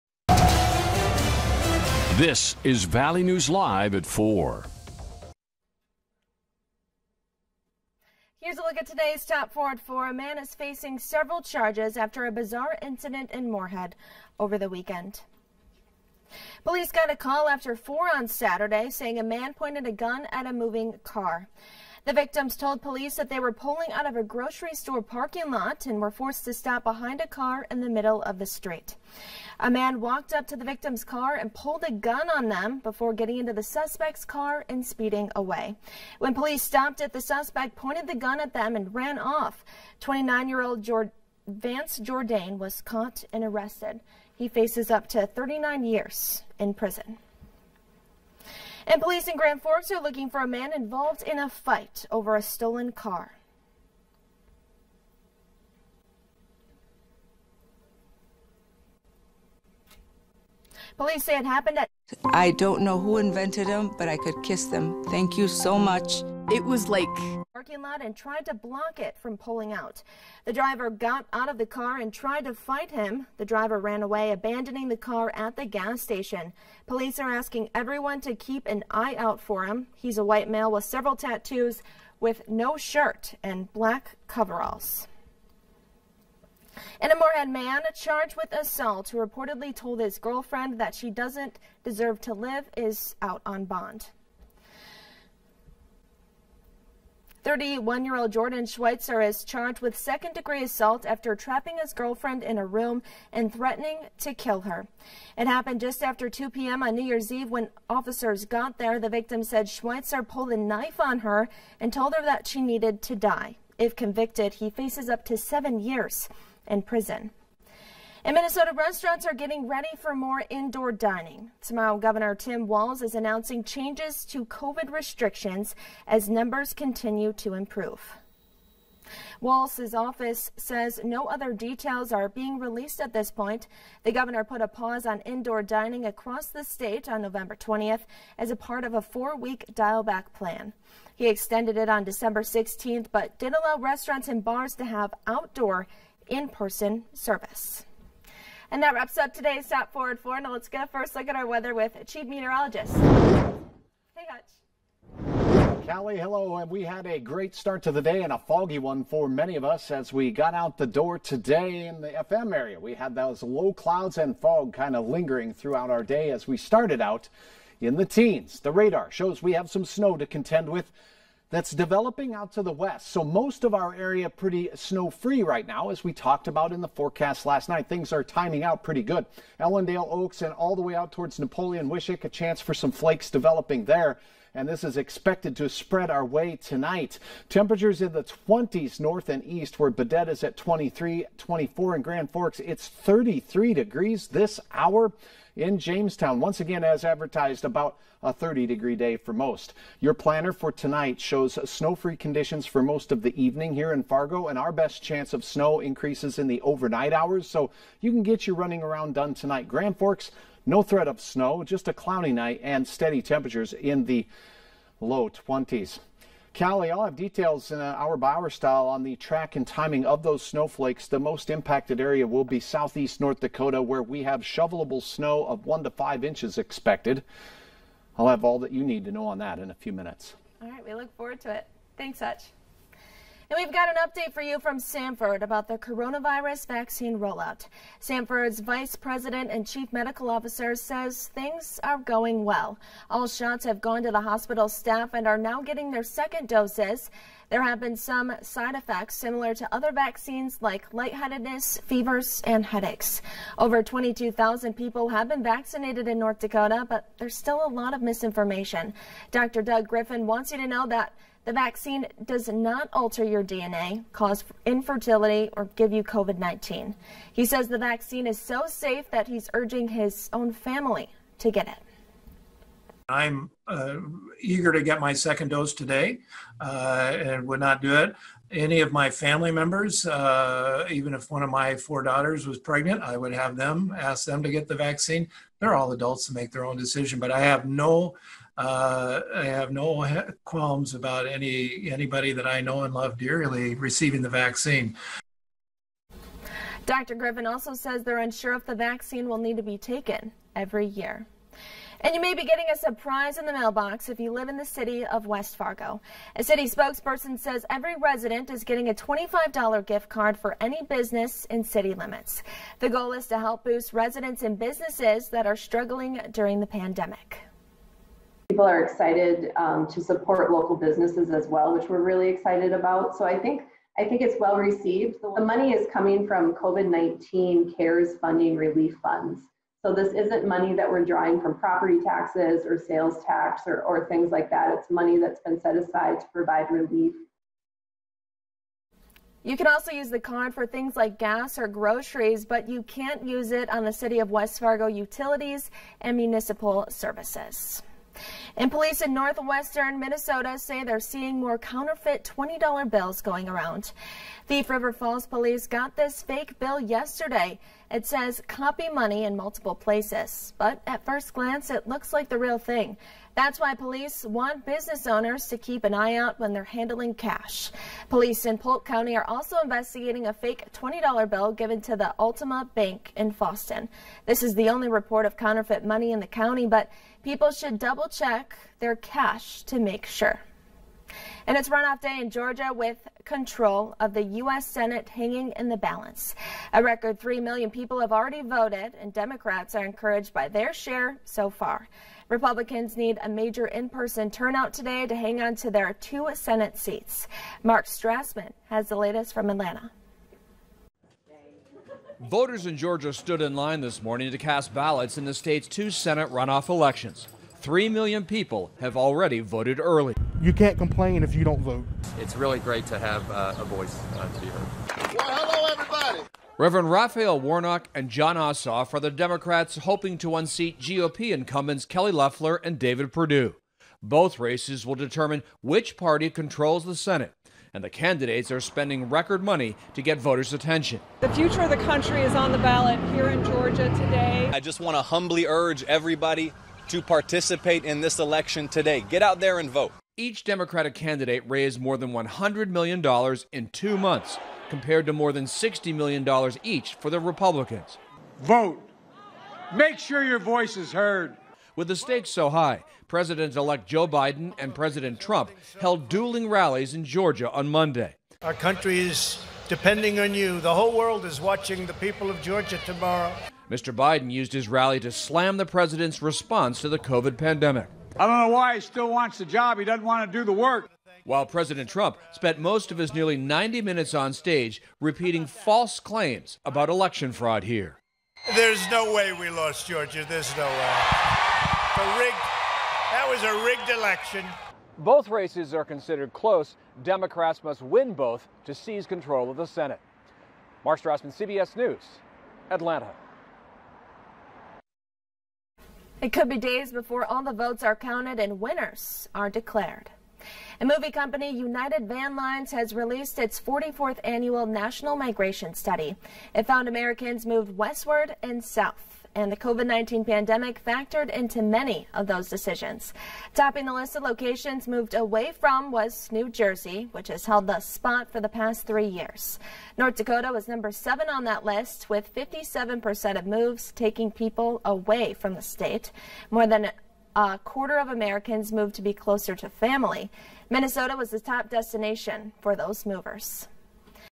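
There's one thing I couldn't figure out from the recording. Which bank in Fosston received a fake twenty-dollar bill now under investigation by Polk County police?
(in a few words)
Ultima Bank.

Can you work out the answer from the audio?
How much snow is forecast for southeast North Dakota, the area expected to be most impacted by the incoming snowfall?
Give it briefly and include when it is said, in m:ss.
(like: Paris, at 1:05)
1 to 5 inches, at 3:45.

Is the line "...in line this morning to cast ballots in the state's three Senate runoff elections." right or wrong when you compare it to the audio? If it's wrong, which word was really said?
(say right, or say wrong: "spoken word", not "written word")
wrong: "two", not "three".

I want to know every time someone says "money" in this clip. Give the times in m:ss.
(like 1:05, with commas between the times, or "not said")
5:25, 5:30, 5:34, 5:58, 6:15, 7:09.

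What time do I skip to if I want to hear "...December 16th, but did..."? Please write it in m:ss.
2:22.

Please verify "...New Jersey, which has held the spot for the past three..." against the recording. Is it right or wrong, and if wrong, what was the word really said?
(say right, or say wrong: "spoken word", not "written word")
right.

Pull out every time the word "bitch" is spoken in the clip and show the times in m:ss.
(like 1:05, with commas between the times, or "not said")
not said.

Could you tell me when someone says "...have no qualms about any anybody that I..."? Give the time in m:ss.
4:49.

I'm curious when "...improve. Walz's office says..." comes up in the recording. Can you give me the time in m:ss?
2:07.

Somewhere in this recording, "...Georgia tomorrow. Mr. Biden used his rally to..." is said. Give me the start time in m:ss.
7:42.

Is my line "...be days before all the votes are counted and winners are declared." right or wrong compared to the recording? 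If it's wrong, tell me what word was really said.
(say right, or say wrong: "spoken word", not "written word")
right.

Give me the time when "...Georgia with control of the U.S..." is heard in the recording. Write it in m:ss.
6:22.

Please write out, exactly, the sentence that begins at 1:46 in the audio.
on New Year's Eve when officers got there.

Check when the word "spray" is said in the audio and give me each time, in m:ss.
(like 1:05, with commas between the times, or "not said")
not said.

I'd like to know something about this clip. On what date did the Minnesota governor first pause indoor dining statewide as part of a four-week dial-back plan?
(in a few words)
November 20th.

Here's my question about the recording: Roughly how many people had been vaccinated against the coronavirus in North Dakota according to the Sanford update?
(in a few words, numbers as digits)
Over 22,000.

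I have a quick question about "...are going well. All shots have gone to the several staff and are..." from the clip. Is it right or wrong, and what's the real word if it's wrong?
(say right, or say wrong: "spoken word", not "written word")
wrong: "hospital", not "several".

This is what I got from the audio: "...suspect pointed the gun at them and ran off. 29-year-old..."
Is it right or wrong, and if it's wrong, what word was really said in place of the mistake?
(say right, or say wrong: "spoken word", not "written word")
right.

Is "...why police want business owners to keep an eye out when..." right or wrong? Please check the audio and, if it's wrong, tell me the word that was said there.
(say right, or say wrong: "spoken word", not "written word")
right.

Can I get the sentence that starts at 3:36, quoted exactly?
Callie, I'll have details in an uh, hour by hour style on the track and timing of those snowflakes.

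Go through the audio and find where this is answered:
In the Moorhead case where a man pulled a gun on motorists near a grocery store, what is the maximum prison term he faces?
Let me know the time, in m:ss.
0:45.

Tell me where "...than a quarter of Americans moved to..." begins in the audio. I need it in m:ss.
8:46.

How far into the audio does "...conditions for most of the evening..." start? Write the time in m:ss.
3:22.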